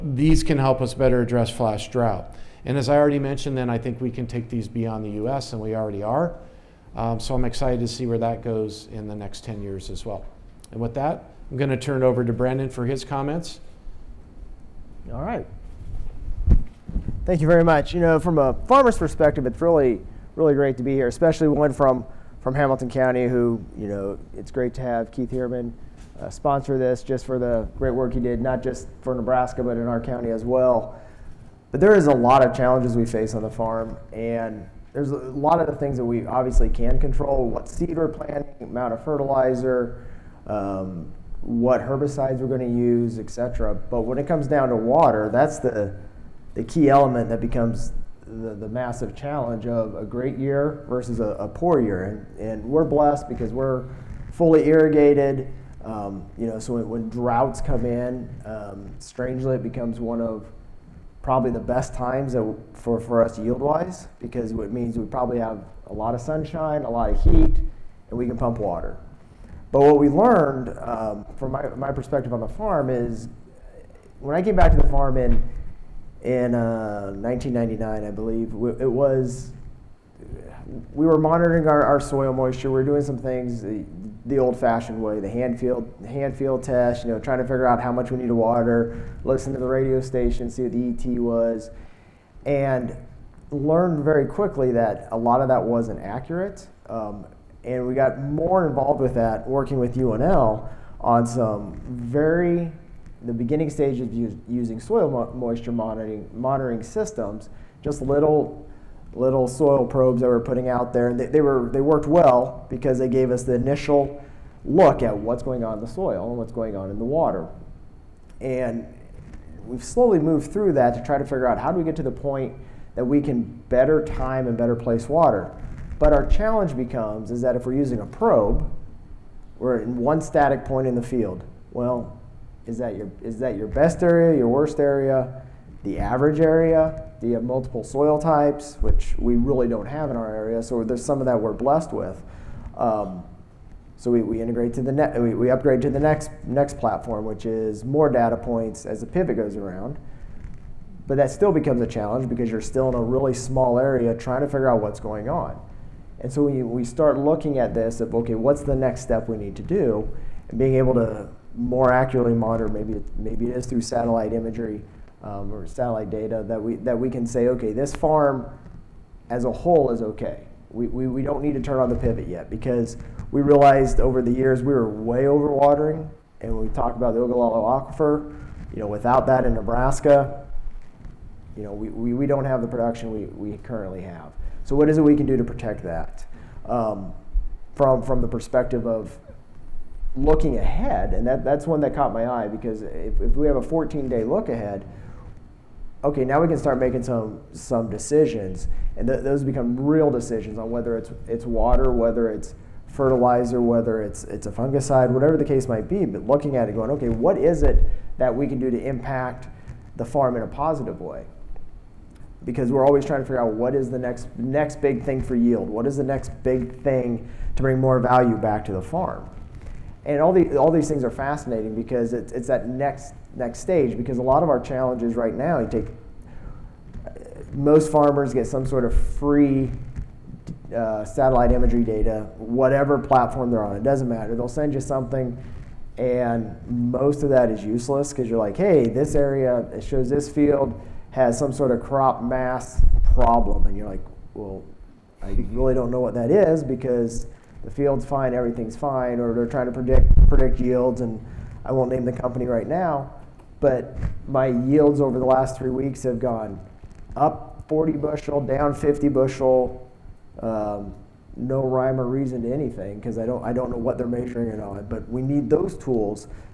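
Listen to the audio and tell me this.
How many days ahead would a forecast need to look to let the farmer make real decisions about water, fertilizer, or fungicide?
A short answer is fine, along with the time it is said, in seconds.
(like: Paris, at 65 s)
14, at 193 s.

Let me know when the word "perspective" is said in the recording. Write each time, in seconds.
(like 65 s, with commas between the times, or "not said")
18 s, 71 s, 188 s.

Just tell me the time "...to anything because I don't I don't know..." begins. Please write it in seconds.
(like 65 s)
262 s.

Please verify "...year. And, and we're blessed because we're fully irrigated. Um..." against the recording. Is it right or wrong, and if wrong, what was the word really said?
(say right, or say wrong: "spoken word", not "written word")
right.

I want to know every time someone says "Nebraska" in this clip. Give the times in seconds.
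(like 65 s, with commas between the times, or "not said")
29 s, 179 s.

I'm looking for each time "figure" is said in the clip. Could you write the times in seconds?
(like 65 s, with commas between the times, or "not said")
87 s, 121 s, 154 s, 213 s.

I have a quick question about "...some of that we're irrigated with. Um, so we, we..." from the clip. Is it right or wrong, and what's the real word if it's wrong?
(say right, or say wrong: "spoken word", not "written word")
wrong: "blessed", not "irrigated".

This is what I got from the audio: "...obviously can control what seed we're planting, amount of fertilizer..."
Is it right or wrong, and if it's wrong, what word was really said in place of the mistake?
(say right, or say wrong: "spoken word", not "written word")
right.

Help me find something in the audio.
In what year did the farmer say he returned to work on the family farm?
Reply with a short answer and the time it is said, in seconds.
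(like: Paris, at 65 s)
1999, at 77 s.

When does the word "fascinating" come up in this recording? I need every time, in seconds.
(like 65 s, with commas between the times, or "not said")
221 s.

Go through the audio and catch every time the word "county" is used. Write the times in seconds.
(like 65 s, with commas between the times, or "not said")
22 s, 30 s.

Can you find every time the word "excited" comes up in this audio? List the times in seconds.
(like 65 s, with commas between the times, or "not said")
7 s.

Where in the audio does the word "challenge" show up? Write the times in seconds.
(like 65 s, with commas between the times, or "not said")
32 s, 49 s, 126 s, 151 s, 224 s.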